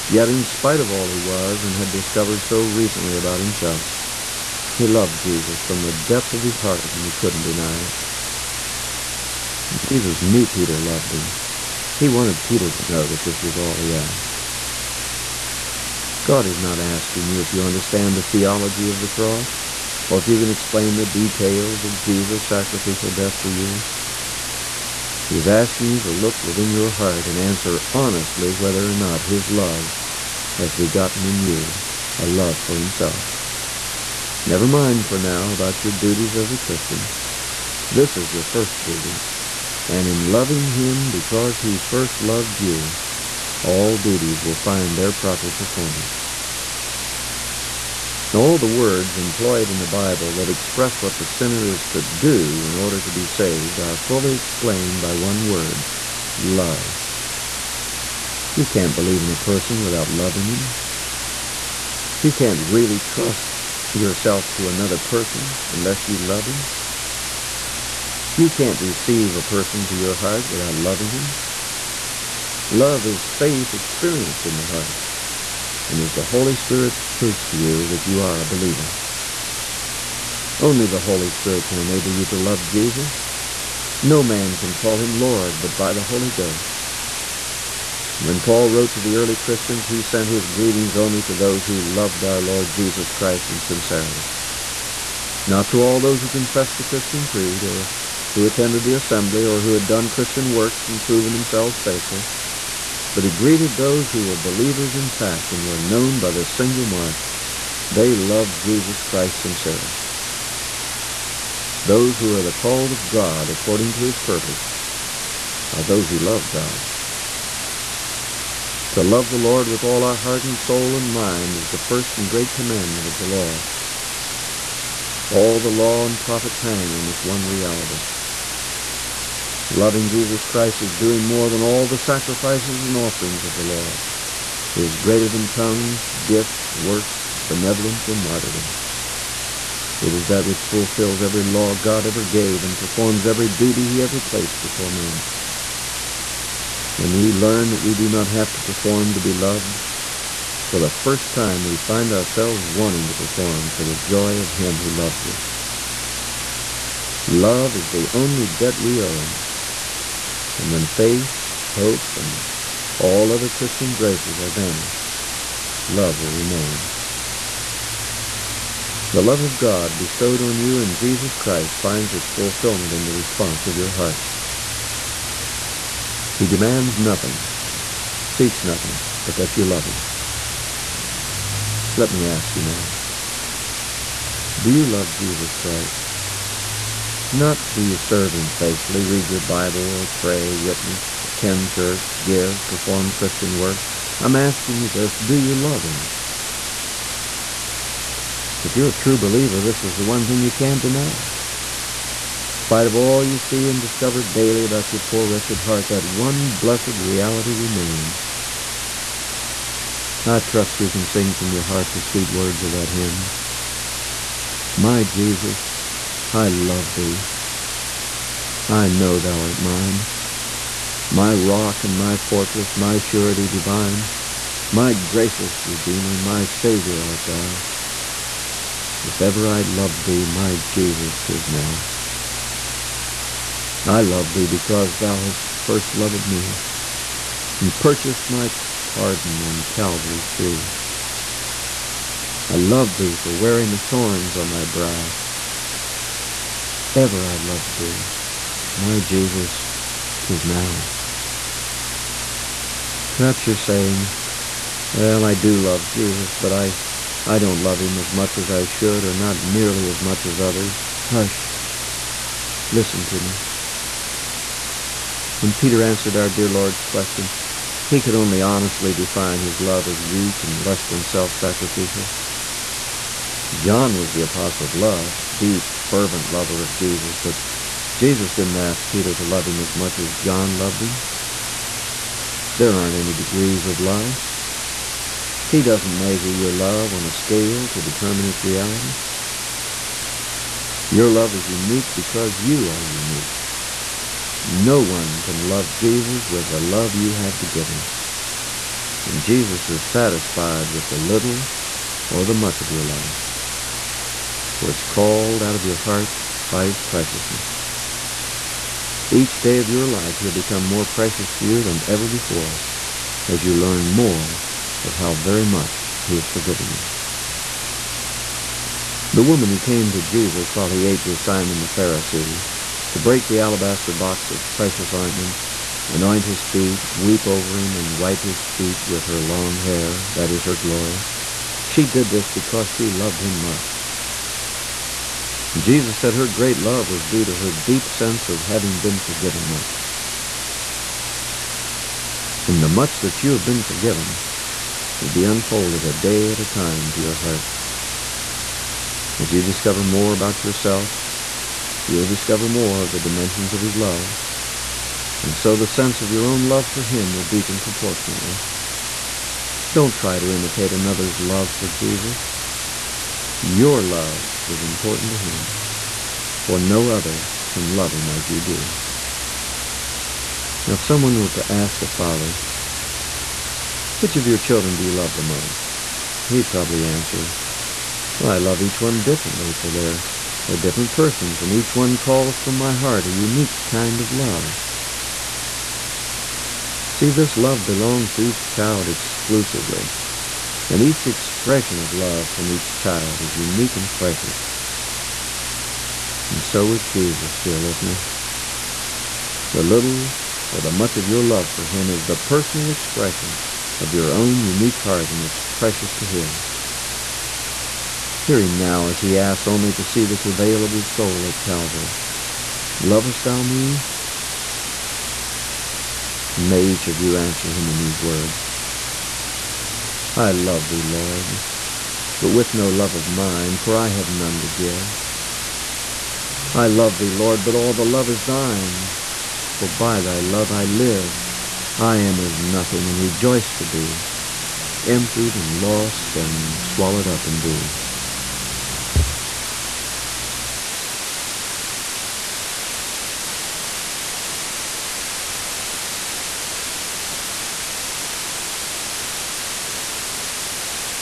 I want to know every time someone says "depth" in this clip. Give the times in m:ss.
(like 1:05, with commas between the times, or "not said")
0:05.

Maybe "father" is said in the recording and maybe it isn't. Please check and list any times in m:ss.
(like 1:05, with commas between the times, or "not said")
6:11.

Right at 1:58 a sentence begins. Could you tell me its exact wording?
To love the Lord with all our heart and soul and mind is the first and great commandment of the law.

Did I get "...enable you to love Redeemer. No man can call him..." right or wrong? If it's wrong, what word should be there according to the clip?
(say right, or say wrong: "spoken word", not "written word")
wrong: "Jesus", not "Redeemer".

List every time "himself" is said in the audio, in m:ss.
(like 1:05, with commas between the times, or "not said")
0:03, 0:32.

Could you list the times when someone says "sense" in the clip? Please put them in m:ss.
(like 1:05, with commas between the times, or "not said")
5:37, 5:55.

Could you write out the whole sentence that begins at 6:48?
Hear him now as he asks only to see the travail of his soul at Calvary.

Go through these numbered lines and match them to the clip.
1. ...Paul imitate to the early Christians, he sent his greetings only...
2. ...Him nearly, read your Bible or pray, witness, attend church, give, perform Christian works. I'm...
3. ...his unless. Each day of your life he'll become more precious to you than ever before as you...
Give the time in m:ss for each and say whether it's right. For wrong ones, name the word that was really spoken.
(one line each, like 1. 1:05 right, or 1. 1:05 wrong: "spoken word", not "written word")
1. 1:28 wrong: "wrote", not "imitate"
2. 3:08 wrong: "faithfully", not "nearly"
3. 5:06 wrong: "preciousness", not "unless".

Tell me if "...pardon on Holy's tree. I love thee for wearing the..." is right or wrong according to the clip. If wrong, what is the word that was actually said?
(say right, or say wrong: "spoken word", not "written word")
wrong: "Calvary", not "Holy".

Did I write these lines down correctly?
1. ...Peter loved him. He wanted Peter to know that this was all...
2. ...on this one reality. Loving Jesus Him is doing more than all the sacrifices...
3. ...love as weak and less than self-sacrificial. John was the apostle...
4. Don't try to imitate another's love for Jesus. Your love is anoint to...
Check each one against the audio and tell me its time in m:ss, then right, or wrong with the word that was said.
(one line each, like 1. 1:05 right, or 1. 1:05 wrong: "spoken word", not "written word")
1. 0:10 right
2. 2:06 wrong: "Christ", not "Him"
3. 4:29 right
4. 5:59 wrong: "important", not "anoint".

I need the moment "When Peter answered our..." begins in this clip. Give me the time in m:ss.
4:25.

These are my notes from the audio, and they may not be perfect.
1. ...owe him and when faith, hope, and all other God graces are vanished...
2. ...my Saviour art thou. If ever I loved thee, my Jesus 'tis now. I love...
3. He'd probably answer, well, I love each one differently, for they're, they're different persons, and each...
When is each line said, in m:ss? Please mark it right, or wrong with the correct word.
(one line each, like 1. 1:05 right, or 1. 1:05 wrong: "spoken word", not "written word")
1. 2:39 wrong: "Christian", not "God"
2. 3:46 right
3. 6:16 right.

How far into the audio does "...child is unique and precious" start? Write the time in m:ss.
6:32.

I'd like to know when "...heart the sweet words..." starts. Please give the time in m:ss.
3:31.